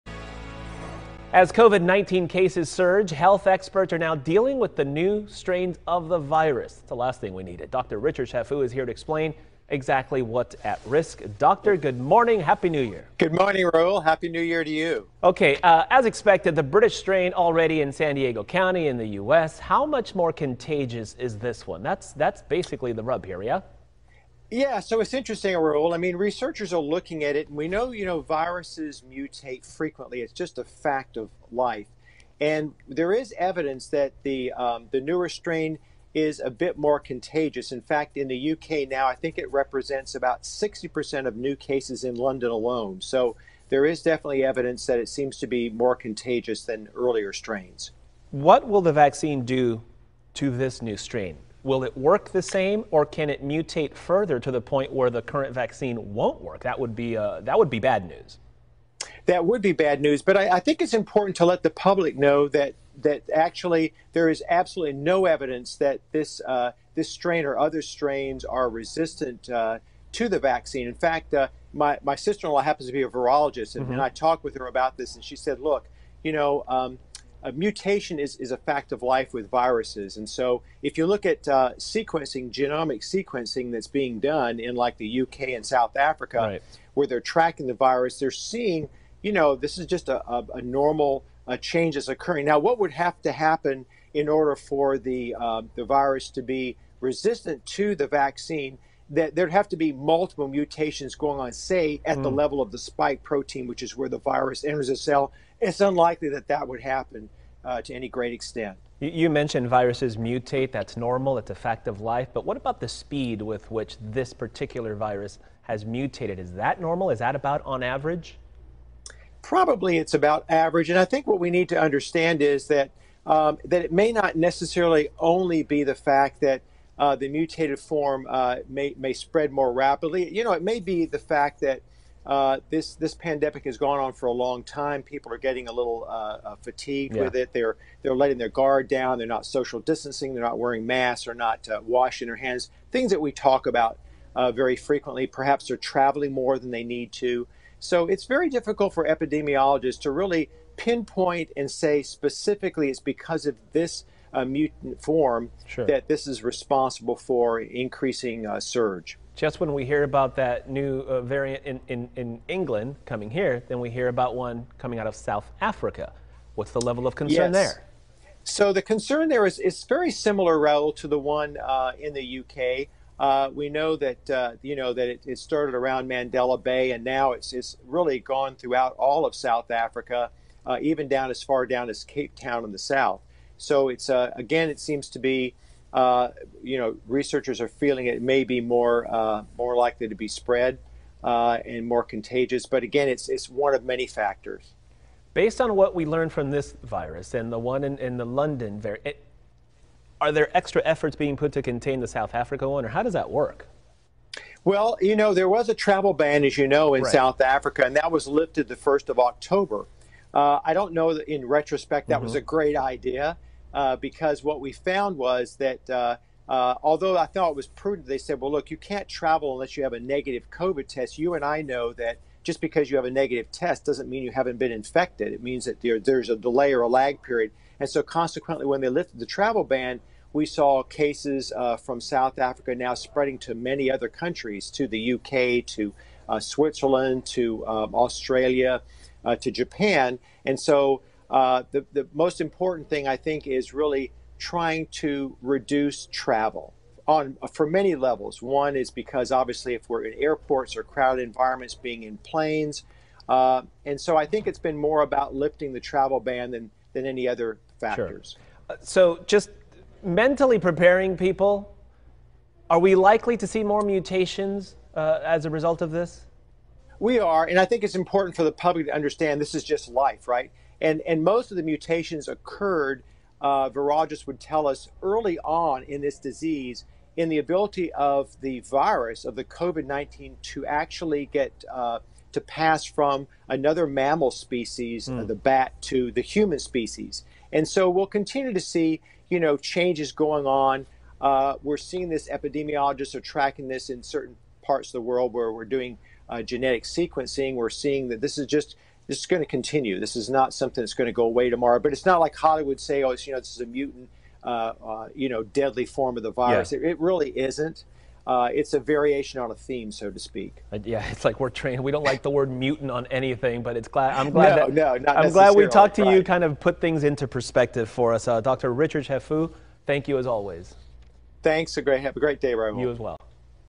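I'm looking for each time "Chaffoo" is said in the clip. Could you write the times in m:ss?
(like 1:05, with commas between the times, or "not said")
0:08, 5:19.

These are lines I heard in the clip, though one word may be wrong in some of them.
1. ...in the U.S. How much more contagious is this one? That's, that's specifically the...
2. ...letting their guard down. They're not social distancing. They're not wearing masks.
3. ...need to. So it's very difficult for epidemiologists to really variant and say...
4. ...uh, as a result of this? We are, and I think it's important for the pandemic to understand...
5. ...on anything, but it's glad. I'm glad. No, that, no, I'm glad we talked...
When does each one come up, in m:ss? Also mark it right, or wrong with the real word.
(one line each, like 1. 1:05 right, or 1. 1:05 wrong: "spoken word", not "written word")
1. 0:18 wrong: "basically", not "specifically"
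2. 2:18 right
3. 2:26 wrong: "pinpoint", not "variant"
4. 4:24 wrong: "public", not "pandemic"
5. 5:12 right.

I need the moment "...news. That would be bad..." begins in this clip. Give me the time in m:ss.
0:58.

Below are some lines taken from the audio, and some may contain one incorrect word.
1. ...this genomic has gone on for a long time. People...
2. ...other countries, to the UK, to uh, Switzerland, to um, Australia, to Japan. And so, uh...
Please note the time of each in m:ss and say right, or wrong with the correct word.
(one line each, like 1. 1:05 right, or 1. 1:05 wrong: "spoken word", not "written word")
1. 2:12 wrong: "pandemic", not "genomic"
2. 3:53 right.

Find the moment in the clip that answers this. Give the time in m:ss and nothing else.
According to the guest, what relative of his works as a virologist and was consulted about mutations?
1:12.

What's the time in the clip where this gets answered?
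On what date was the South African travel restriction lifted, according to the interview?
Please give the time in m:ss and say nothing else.
3:28.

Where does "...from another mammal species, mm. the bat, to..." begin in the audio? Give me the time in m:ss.
4:42.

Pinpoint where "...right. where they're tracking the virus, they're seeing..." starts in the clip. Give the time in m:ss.
1:26.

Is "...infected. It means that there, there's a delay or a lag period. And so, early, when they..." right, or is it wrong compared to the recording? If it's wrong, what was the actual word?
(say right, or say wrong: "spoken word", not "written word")
wrong: "consequently", not "early".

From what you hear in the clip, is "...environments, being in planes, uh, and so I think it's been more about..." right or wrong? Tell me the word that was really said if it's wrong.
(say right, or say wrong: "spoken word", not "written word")
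right.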